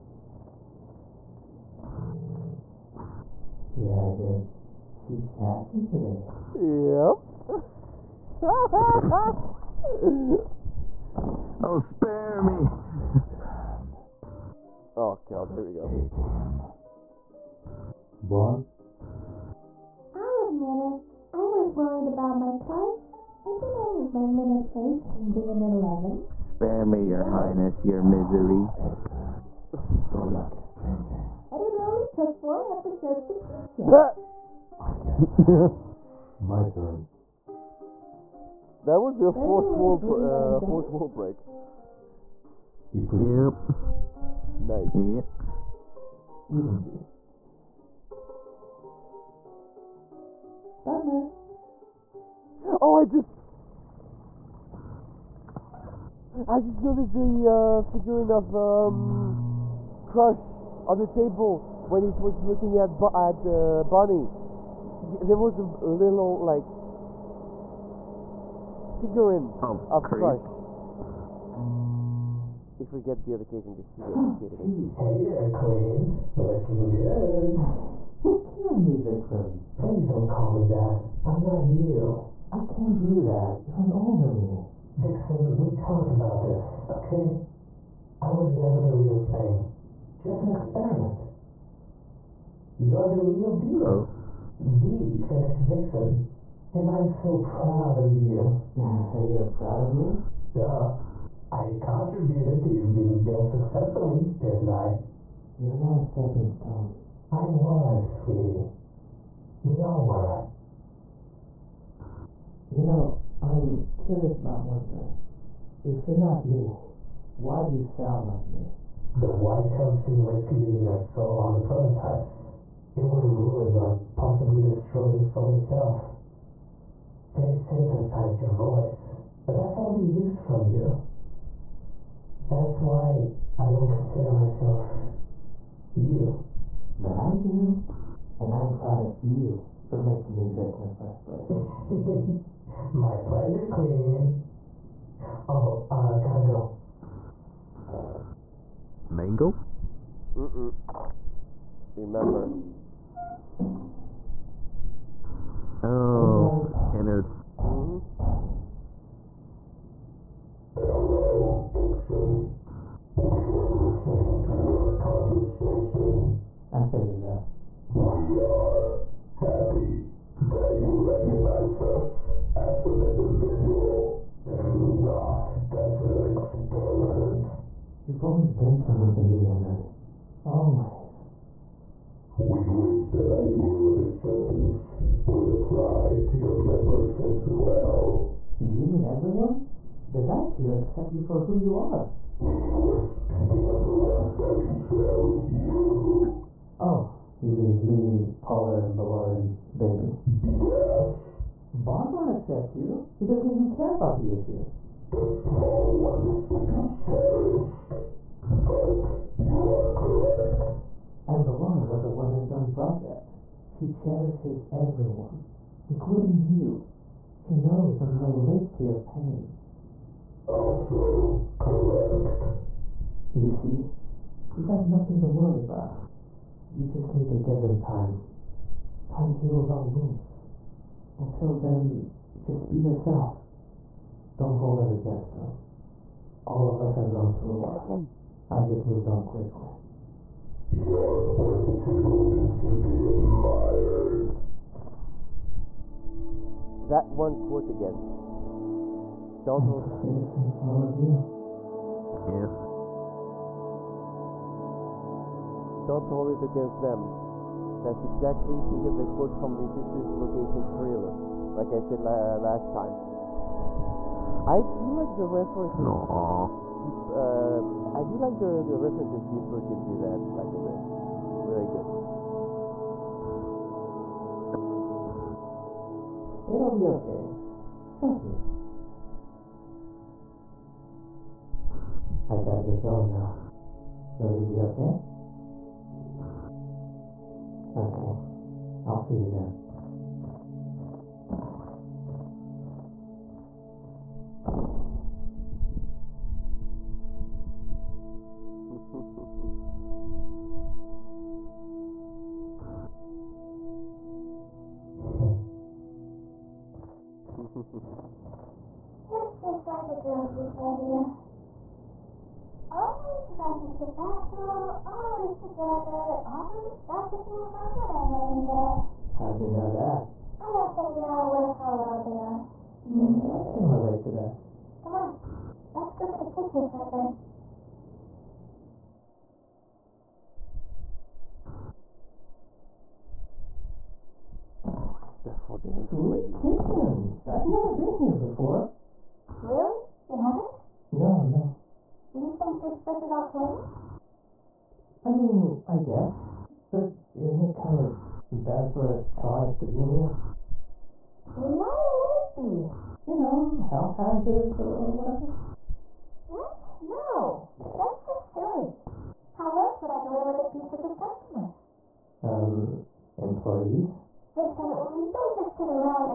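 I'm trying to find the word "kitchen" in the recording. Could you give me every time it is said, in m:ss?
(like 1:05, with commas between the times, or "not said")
5:26, 5:36.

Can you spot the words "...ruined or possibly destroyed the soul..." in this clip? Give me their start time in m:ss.
2:03.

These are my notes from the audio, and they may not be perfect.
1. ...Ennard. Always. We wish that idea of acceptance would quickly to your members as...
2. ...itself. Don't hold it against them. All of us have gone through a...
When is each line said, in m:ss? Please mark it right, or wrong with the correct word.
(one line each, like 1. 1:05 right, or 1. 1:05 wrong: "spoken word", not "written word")
1. 2:59 wrong: "apply", not "quickly"
2. 3:52 wrong: "yourself", not "itself".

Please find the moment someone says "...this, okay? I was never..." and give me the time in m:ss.
1:26.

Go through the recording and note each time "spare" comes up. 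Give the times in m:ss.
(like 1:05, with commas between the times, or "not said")
0:11, 0:26.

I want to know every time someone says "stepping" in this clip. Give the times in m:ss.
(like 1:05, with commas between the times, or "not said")
1:46.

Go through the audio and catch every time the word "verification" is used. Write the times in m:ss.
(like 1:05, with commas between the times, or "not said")
not said.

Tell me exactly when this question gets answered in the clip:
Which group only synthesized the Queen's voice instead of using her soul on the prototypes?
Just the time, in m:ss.
1:59.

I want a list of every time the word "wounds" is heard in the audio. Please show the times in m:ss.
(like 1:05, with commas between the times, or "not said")
3:49.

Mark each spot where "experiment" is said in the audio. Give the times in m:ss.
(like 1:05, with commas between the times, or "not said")
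1:30, 2:56.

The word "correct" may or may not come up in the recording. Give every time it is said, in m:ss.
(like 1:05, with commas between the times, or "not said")
3:29, 3:41.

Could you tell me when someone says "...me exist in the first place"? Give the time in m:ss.
2:20.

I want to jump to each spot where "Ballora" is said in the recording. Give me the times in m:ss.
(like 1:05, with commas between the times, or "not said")
3:18, 3:31.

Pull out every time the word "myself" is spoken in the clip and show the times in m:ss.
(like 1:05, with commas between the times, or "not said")
2:14.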